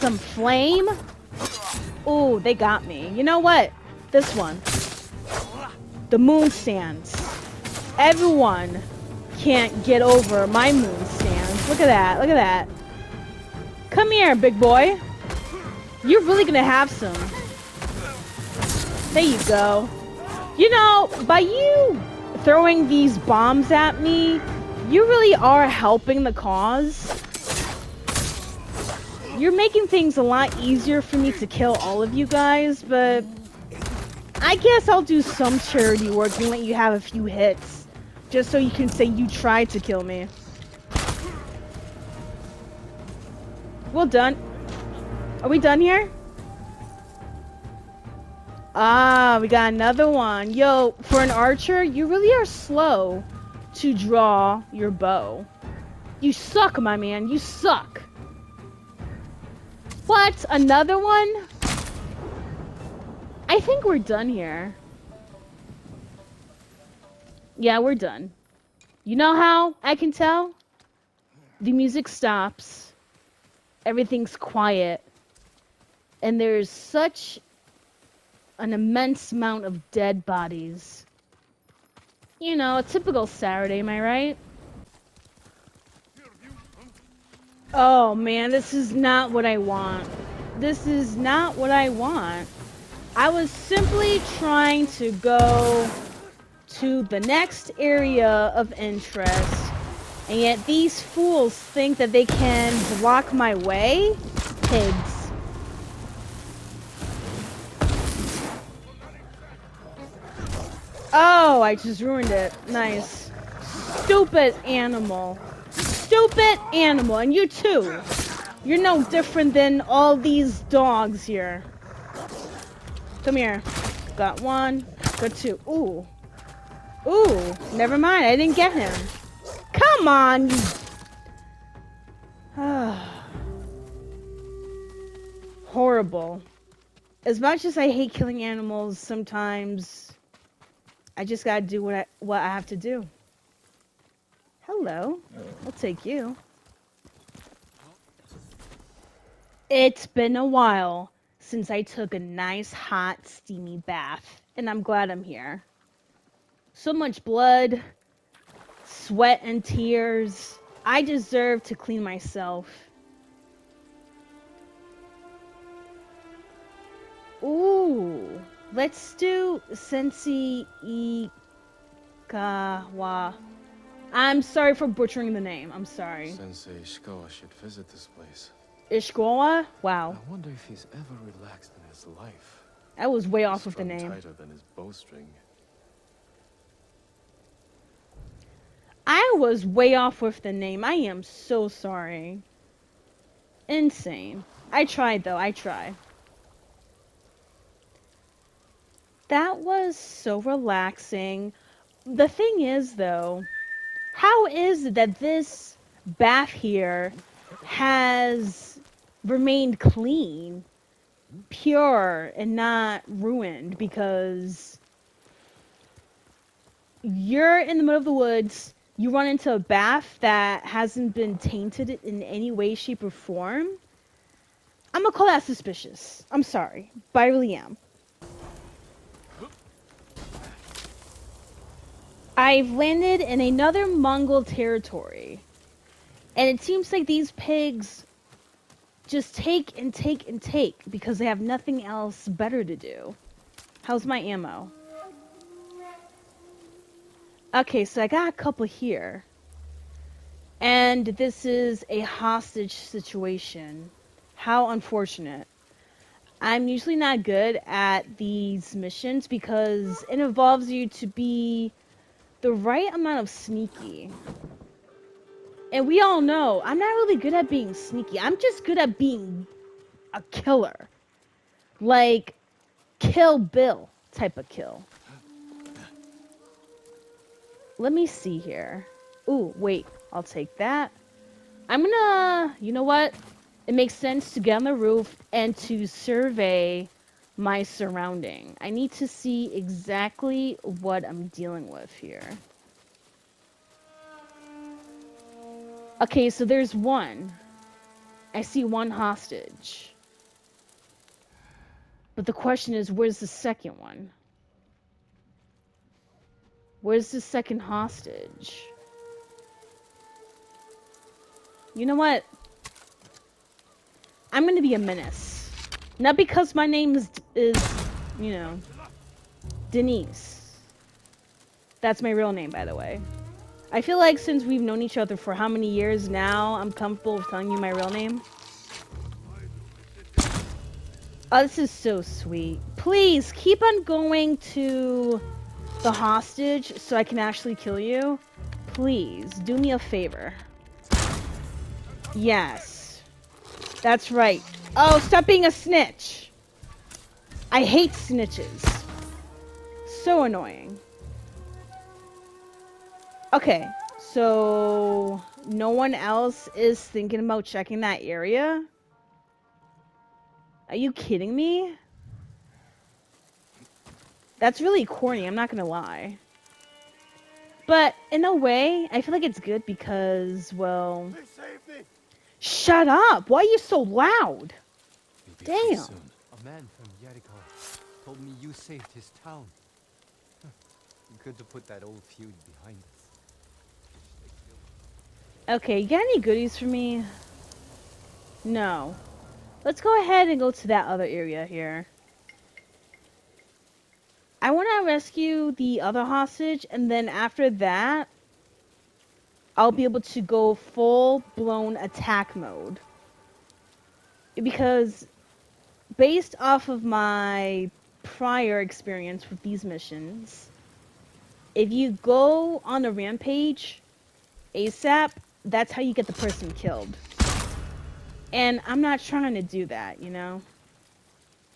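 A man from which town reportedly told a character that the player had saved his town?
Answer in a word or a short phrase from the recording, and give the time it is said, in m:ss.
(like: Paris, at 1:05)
Yarikawa, at 6:17.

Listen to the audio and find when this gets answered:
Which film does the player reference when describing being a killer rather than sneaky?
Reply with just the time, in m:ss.
4:32.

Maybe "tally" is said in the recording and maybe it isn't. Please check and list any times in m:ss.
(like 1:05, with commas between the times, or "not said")
not said.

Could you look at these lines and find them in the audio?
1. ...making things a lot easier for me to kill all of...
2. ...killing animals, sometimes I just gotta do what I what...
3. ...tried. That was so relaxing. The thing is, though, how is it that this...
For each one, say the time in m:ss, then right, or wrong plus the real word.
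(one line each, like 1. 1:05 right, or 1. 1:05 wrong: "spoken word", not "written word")
1. 0:29 right
2. 2:18 right
3. 3:15 right.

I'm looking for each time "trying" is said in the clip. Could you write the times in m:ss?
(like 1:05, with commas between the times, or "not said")
1:34, 6:59.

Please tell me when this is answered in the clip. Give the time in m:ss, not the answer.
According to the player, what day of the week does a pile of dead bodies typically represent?
1:23.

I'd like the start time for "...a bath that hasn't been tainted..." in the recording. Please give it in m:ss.
3:39.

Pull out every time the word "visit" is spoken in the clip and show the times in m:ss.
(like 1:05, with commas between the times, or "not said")
2:57.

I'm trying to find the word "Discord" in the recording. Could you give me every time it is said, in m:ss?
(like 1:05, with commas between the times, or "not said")
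not said.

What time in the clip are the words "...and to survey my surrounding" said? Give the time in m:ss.
4:45.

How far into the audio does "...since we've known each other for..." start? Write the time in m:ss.
5:24.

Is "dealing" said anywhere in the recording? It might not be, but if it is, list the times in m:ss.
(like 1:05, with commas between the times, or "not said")
4:51.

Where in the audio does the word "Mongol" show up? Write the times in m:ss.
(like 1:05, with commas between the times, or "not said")
3:53.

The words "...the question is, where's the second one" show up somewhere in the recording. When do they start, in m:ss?
5:02.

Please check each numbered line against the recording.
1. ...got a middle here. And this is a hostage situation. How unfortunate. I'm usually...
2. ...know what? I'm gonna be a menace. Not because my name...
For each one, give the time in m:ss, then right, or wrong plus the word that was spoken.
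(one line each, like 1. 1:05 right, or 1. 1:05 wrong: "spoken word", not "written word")
1. 4:08 wrong: "couple", not "middle"
2. 5:11 right.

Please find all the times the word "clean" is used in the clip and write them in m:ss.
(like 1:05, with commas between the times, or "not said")
2:41, 3:29.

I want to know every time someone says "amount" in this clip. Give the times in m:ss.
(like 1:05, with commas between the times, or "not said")
1:19, 4:22.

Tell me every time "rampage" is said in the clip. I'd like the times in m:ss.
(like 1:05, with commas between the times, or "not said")
6:52.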